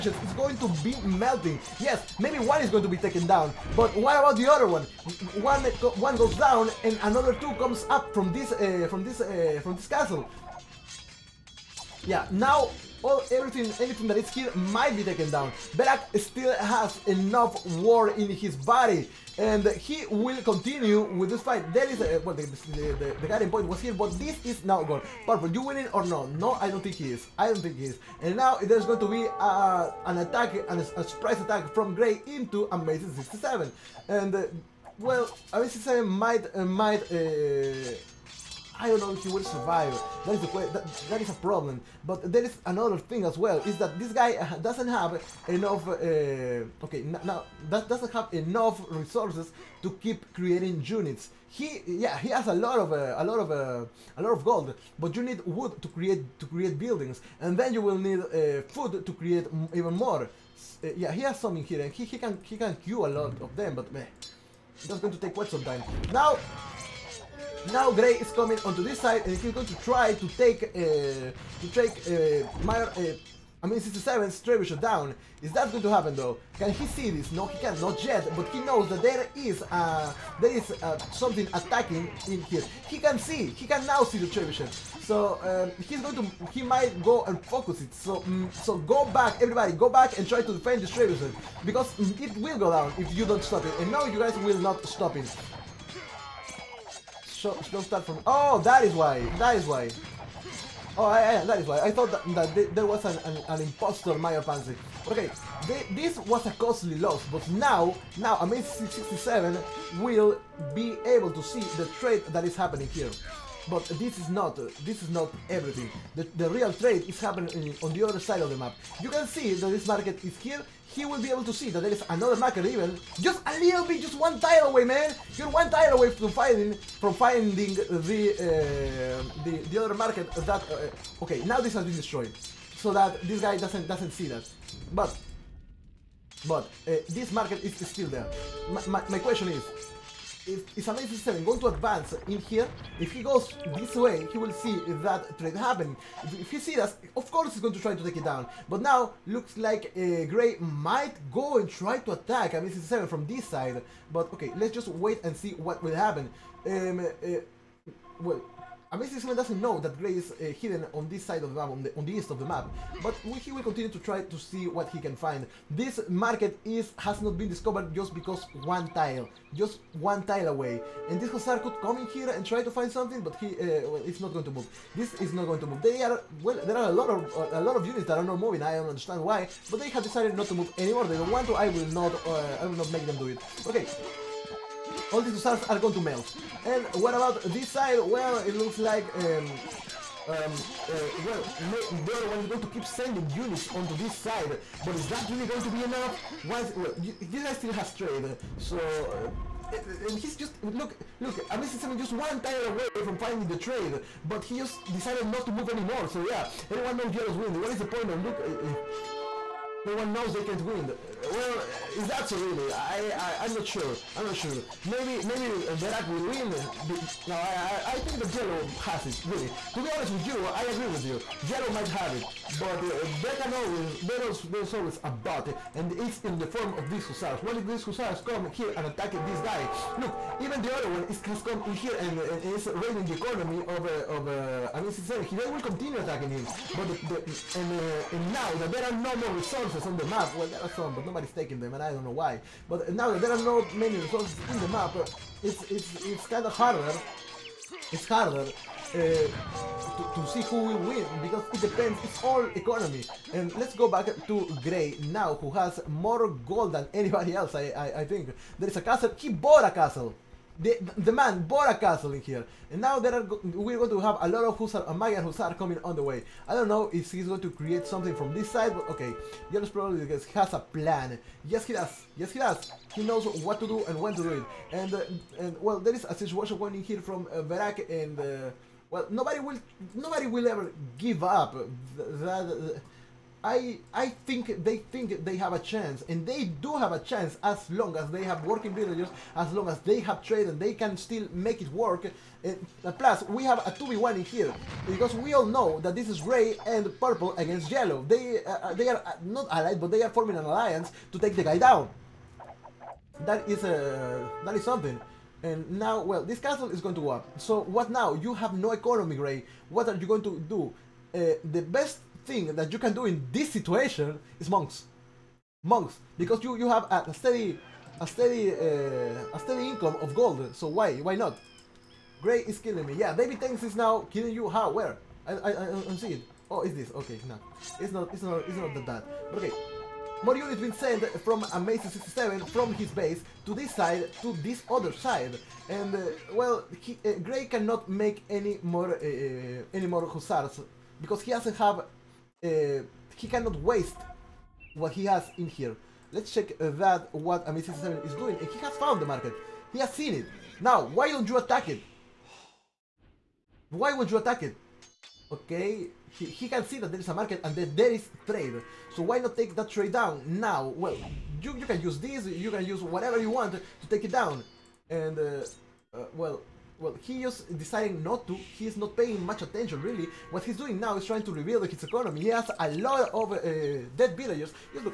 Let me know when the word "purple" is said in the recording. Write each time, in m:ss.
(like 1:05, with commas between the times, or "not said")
0:25, 4:56.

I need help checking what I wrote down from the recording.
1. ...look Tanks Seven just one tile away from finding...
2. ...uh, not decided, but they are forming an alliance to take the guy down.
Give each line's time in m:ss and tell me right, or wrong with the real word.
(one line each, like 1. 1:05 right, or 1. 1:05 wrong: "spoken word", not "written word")
1. 3:21 wrong: "Amazing", not "Tanks"
2. 4:59 wrong: "allied", not "decided".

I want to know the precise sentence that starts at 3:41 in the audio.
Yellow might have it, but uh, there can always there's there's always a but, and it's in the form of these hussars.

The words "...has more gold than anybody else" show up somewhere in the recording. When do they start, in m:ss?
4:15.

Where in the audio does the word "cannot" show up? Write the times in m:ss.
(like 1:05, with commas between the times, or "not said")
5:37, 5:43.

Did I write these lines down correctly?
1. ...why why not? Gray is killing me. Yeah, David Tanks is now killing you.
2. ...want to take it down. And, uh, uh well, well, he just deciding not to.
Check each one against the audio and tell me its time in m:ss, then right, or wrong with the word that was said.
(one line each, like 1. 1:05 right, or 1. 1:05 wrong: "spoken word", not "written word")
1. 5:20 right
2. 6:03 right.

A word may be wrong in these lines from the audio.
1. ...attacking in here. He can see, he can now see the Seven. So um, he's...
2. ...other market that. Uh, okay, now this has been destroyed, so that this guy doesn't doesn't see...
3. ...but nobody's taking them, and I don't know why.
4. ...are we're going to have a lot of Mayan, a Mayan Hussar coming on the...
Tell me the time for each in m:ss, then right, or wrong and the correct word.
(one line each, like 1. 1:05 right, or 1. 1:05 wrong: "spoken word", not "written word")
1. 1:21 wrong: "Trebuchet", not "Seven"
2. 2:09 right
3. 4:00 right
4. 4:23 wrong: "Hussar", not "Mayan".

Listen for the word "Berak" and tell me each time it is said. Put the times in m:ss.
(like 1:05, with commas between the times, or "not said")
0:15, 3:35, 4:37.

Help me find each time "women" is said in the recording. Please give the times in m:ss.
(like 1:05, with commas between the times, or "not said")
not said.